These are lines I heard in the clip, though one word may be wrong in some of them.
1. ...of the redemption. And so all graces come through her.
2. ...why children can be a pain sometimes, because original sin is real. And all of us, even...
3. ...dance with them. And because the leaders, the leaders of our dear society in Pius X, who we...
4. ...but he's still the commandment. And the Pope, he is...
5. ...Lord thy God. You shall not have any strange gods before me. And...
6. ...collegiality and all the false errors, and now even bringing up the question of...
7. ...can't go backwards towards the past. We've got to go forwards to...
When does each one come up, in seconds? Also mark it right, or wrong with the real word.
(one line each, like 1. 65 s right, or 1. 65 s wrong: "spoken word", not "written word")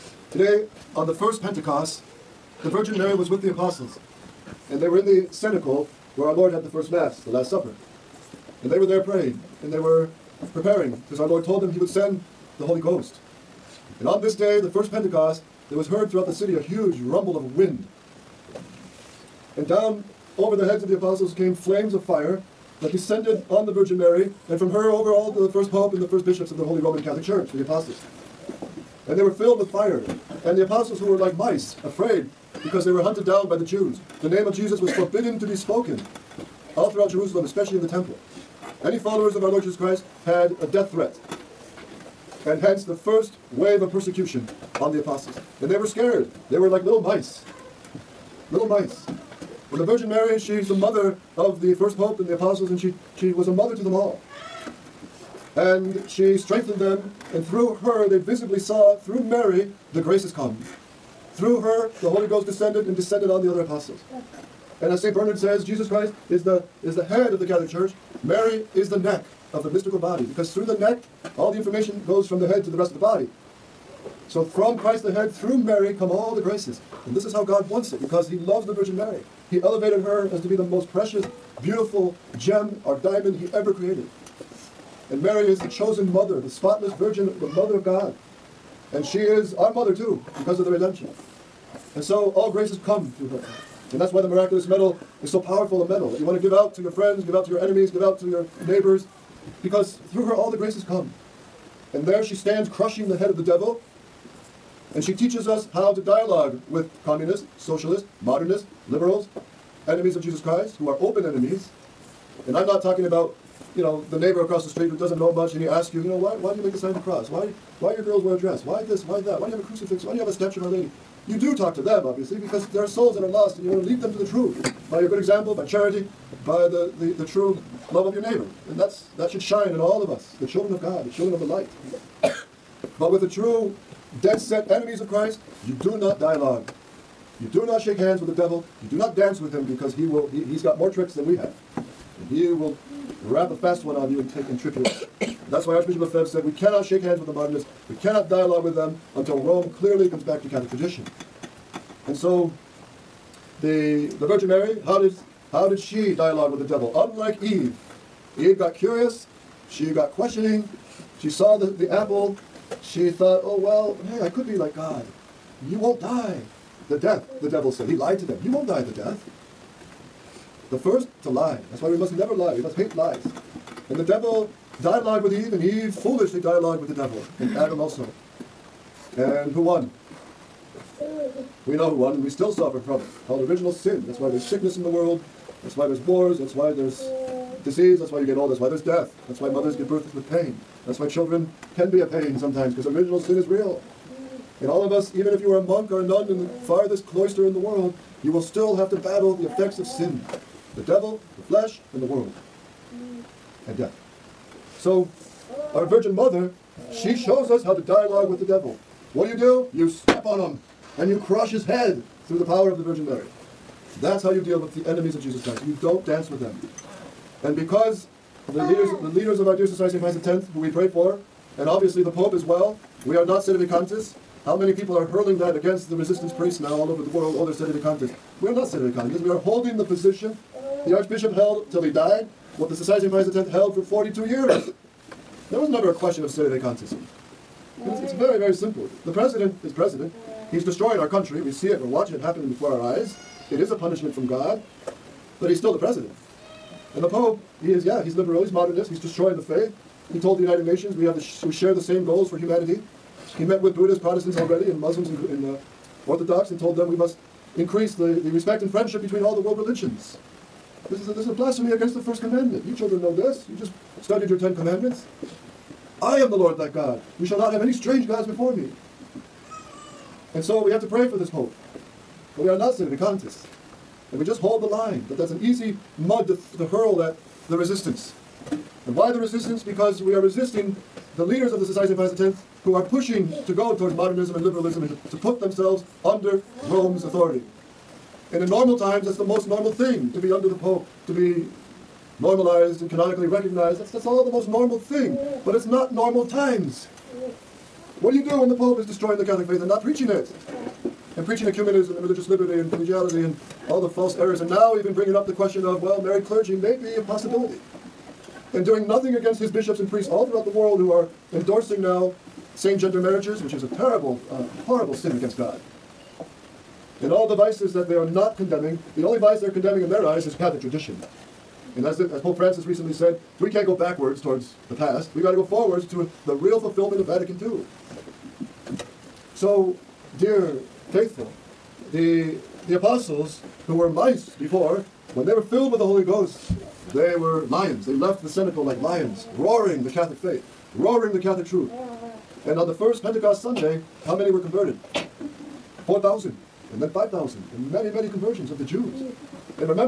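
1. 90 s right
2. 190 s right
3. 216 s right
4. 245 s wrong: "president", not "commandment"
5. 266 s right
6. 302 s right
7. 323 s right.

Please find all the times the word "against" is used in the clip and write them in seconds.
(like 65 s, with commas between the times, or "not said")
225 s, 261 s, 309 s, 315 s.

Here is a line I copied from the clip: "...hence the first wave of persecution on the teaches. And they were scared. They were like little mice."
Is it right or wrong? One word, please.
wrong.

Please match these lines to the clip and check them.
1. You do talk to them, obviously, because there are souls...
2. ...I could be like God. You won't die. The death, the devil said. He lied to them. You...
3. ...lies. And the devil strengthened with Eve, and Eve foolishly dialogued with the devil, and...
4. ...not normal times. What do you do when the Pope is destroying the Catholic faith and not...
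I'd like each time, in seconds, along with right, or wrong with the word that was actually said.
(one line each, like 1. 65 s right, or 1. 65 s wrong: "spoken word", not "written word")
1. 121 s right
2. 164 s right
3. 172 s wrong: "dialogued", not "strengthened"
4. 295 s right.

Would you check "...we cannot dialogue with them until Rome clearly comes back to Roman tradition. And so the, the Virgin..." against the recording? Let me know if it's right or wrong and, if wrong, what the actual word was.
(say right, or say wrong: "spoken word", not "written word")
wrong: "Catholic", not "Roman".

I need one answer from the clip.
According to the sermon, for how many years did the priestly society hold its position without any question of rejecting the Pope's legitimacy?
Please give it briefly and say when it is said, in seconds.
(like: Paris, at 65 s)
42, at 233 s.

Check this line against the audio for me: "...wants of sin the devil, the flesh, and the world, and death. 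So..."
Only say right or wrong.
wrong.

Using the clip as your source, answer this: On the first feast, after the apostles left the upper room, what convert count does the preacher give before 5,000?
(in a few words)
4,000.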